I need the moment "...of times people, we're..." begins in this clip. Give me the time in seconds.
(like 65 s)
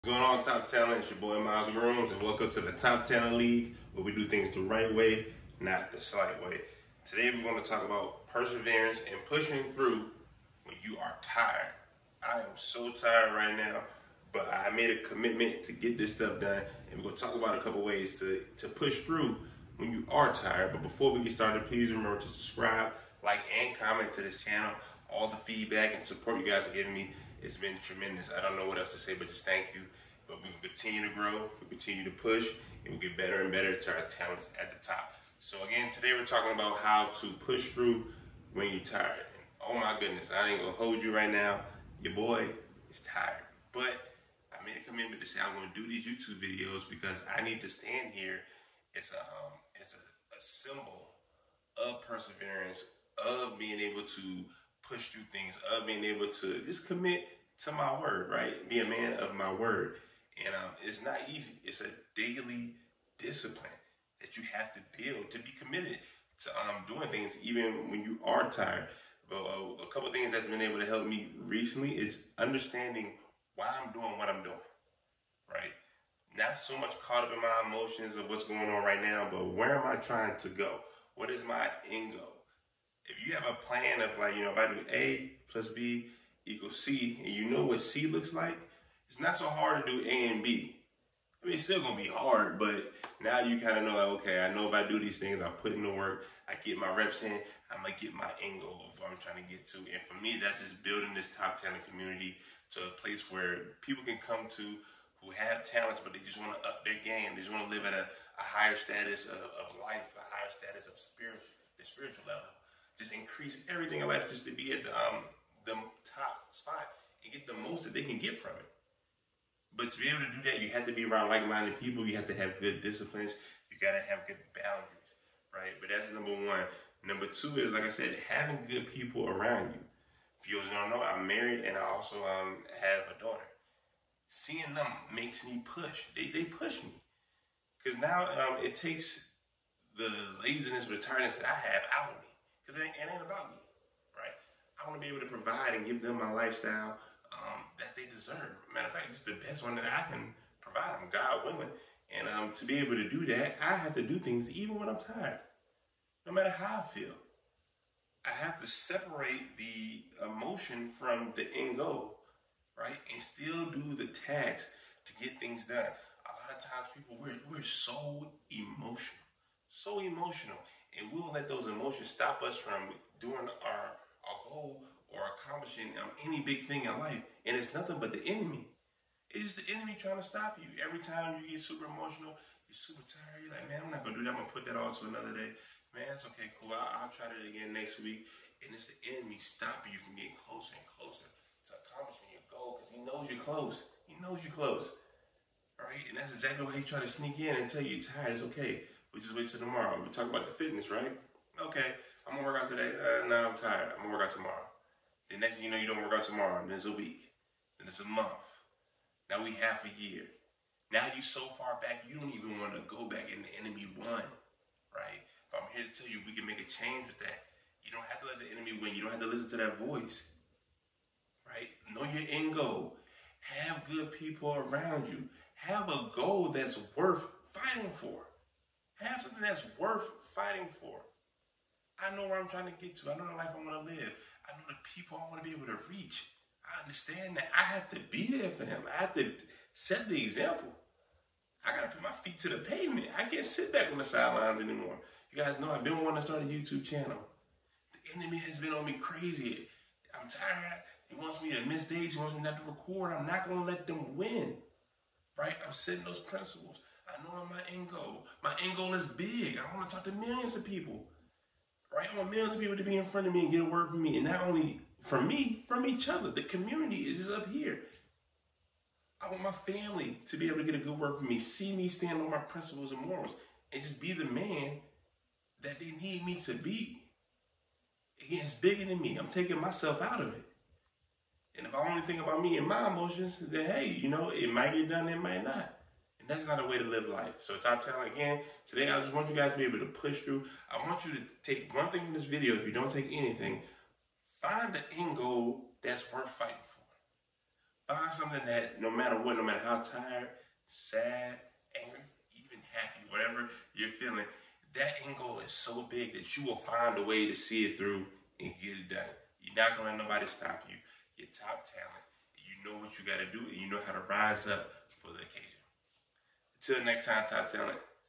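166 s.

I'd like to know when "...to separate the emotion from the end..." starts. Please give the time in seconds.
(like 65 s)
158 s.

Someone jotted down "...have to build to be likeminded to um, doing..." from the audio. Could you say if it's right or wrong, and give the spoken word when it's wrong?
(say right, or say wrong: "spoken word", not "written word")
wrong: "committed", not "likeminded".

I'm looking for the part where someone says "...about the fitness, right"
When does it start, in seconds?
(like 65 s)
200 s.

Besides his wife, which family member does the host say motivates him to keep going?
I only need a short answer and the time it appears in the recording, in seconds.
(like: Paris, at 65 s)
daughter, at 133 s.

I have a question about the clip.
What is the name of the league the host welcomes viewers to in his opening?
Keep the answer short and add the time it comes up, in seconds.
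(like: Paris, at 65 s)
Top Talent League, at 2 s.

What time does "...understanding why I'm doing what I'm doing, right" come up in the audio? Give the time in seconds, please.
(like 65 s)
72 s.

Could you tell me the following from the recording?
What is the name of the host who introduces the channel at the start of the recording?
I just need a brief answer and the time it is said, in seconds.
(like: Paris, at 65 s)
Miles Grooms, at 1 s.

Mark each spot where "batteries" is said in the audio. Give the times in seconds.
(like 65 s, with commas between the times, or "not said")
not said.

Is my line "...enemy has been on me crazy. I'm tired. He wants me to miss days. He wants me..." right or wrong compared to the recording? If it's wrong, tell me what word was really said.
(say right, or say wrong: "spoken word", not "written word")
right.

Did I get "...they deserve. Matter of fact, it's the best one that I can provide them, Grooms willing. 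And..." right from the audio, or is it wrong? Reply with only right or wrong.
wrong.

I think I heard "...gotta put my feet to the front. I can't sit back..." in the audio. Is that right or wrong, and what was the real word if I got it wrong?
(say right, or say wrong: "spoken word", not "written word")
wrong: "pavement", not "front".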